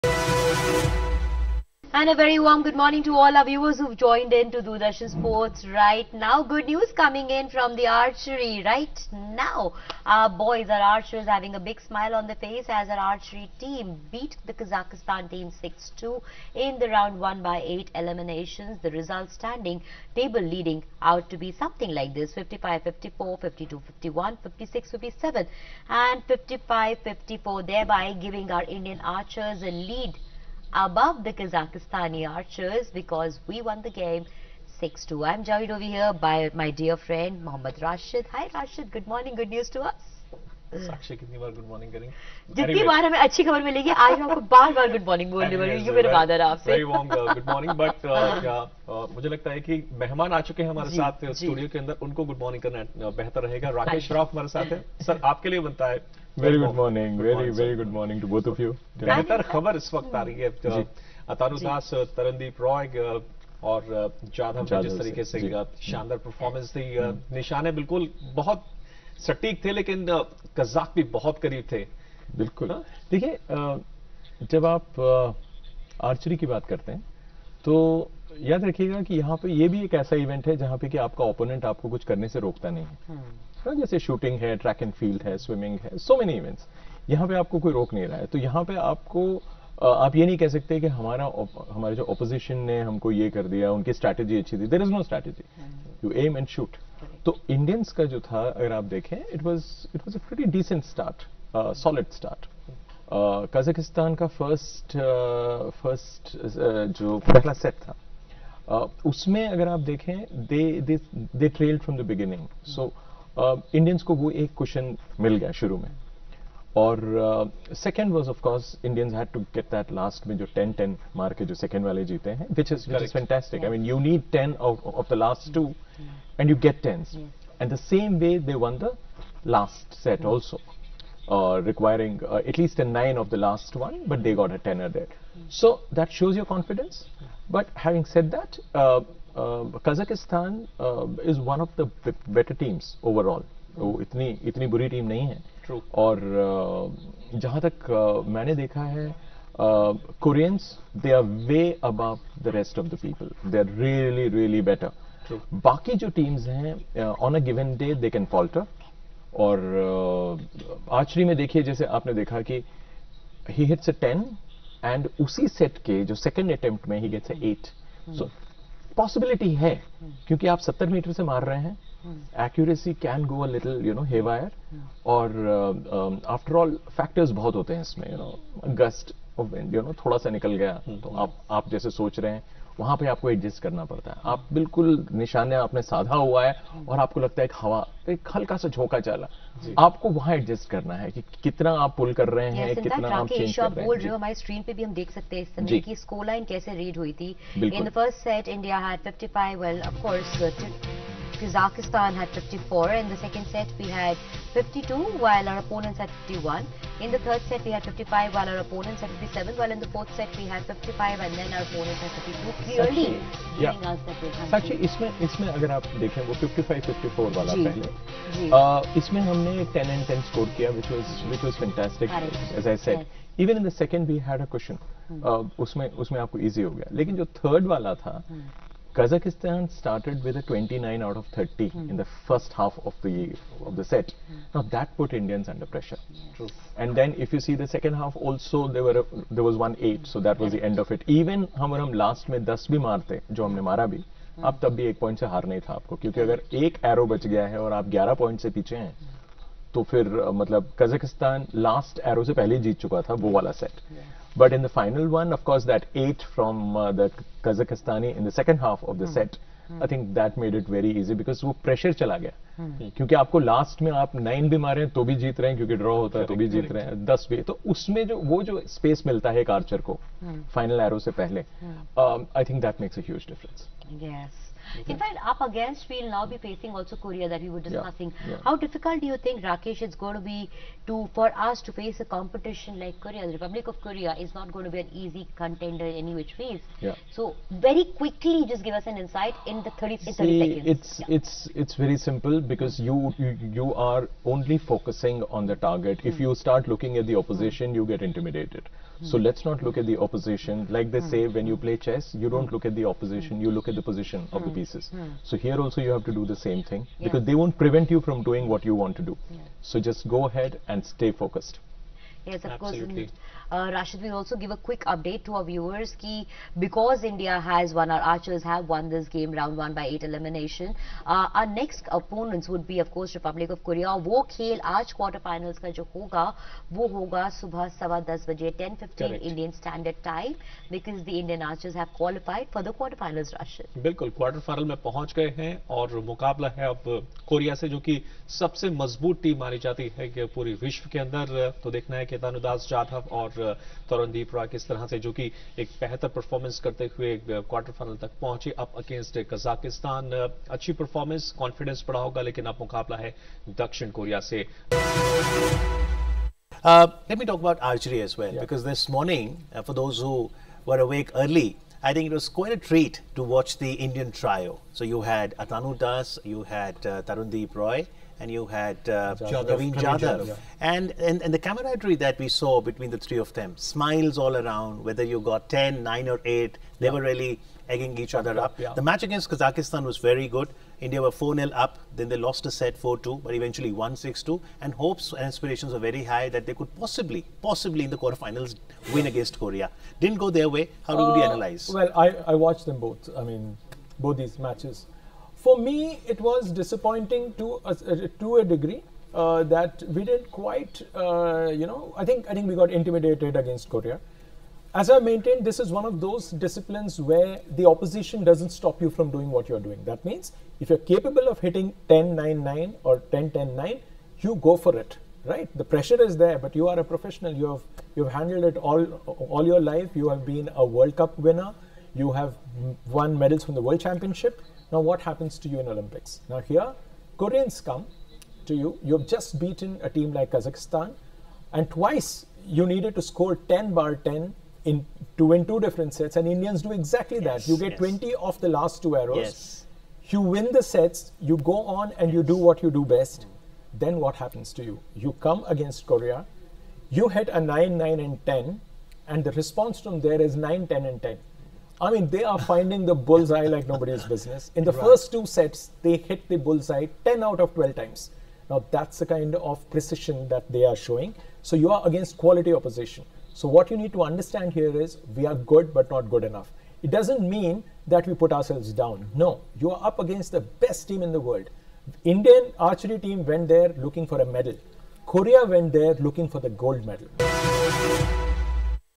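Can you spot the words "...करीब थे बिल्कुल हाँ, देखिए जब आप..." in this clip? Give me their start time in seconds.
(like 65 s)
71 s.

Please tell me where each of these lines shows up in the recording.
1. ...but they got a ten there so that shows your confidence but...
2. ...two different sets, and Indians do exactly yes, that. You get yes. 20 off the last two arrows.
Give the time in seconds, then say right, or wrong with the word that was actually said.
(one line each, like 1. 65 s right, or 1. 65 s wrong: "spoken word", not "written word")
1. 134 s right
2. 435 s right.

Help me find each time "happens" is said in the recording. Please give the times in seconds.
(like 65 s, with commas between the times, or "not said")
425 s, 444 s.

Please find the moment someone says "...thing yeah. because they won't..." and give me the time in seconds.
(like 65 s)
306 s.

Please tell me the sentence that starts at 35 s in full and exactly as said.
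I'm joined over here by my dear friend Mohammad Rashid.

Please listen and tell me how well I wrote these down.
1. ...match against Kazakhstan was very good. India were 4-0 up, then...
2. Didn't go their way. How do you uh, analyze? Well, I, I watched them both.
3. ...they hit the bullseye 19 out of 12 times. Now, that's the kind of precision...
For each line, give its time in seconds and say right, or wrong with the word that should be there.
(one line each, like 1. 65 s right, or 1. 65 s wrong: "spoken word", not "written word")
1. 378 s right
2. 389 s right
3. 455 s wrong: "10", not "19".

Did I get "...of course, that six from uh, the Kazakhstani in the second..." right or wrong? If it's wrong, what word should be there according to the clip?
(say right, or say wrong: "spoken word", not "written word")
wrong: "eight", not "six".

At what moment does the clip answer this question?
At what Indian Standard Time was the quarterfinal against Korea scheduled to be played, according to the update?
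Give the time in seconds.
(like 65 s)
328 s.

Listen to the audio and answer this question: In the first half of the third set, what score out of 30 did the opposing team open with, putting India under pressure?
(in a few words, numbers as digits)
29.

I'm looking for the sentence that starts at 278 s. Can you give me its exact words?
How difficult do you think, Rakesh, it's going to be to for us to face a competition like Korea?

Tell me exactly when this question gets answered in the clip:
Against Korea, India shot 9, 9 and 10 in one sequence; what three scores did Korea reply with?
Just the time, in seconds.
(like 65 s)
450 s.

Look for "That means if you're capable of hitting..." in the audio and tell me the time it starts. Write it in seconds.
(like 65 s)
409 s.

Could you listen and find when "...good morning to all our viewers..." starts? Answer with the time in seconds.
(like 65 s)
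2 s.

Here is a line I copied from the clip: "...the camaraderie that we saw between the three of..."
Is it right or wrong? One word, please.
right.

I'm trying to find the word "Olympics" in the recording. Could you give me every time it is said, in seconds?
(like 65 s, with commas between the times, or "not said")
425 s.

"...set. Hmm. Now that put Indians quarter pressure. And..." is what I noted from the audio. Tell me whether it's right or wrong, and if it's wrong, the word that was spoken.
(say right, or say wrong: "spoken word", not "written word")
wrong: "under", not "quarter".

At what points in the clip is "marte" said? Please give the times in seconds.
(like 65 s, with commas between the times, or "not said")
242 s.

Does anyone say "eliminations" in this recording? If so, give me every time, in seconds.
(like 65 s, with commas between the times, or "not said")
17 s, 320 s.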